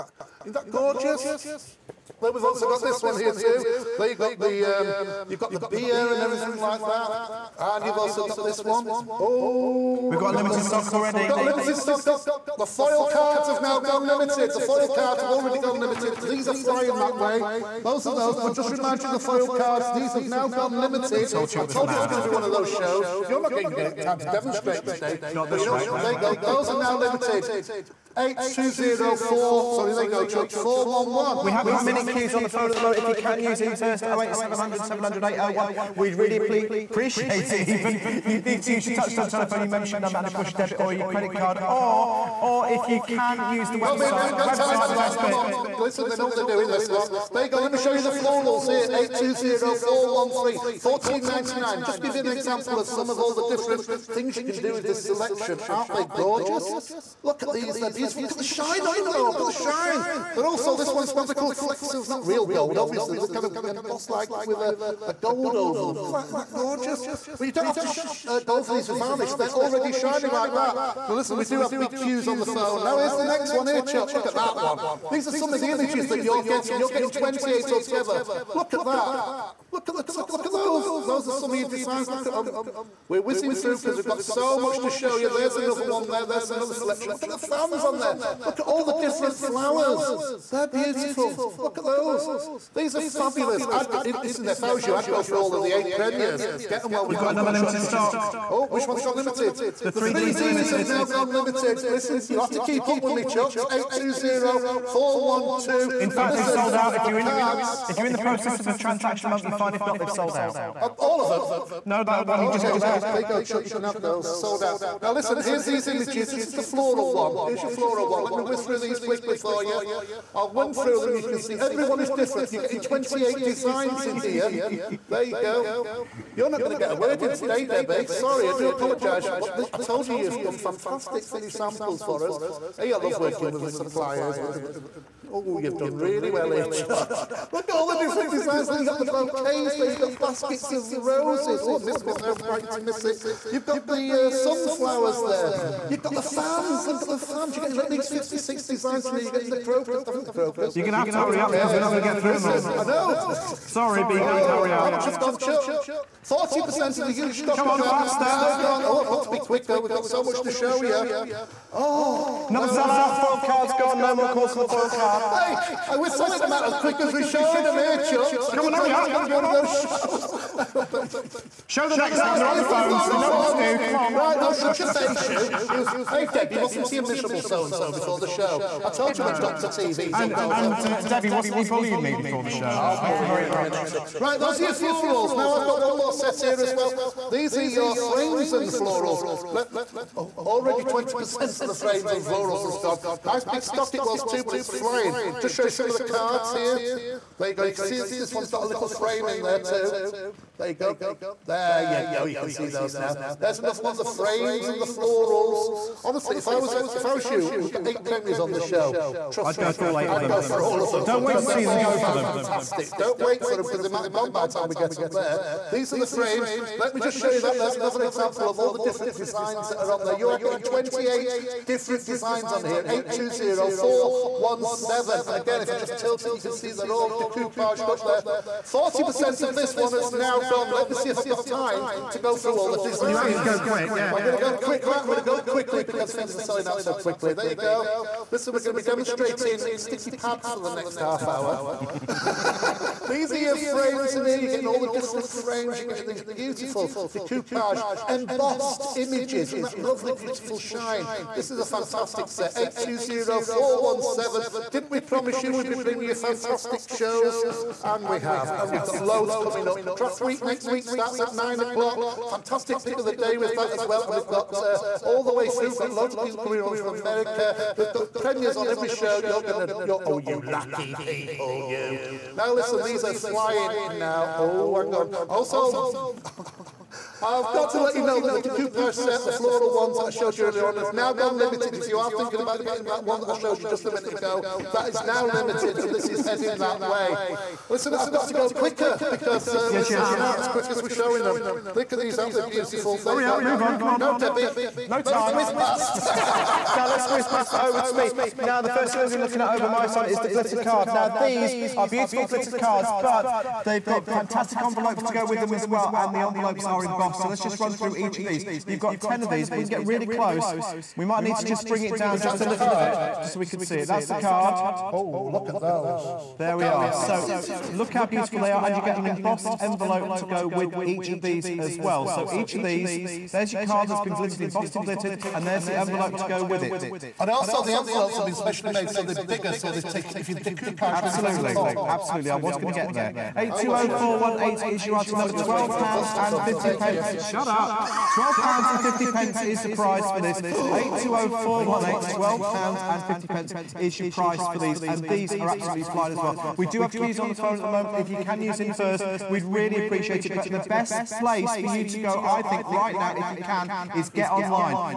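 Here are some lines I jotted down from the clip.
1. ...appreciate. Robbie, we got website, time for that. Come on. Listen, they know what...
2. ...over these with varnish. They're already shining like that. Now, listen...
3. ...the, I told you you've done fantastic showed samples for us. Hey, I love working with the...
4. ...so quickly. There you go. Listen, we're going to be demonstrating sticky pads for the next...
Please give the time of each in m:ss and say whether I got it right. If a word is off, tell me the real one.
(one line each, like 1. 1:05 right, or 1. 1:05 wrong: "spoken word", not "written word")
1. 0:43 wrong: "website", not "appreciate"
2. 1:08 right
3. 2:09 wrong: "finished", not "showed"
4. 3:56 right.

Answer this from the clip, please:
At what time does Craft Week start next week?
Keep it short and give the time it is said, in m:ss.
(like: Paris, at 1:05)
9 o'clock, at 4:21.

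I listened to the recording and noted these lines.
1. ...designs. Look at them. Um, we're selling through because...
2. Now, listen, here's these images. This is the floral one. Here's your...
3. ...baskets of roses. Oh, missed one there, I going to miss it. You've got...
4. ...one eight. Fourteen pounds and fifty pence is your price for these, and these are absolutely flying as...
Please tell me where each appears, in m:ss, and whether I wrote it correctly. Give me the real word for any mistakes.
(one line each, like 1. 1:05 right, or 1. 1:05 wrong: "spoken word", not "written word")
1. 1:21 wrong: "whizzing", not "selling"
2. 1:55 right
3. 2:20 right
4. 5:41 wrong: "Twelve", not "Fourteen".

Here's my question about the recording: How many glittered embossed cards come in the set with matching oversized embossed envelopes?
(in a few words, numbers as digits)
10.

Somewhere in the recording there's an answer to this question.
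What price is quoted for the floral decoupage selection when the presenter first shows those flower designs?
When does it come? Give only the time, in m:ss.
0:50.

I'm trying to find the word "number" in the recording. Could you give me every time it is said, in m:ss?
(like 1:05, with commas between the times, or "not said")
0:40, 5:35.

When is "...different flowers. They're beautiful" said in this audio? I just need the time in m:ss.
1:28.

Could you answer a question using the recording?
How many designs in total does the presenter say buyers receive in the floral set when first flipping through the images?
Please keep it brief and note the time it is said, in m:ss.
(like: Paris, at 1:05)
28, at 1:17.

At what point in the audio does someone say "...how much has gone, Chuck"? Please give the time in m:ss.
2:34.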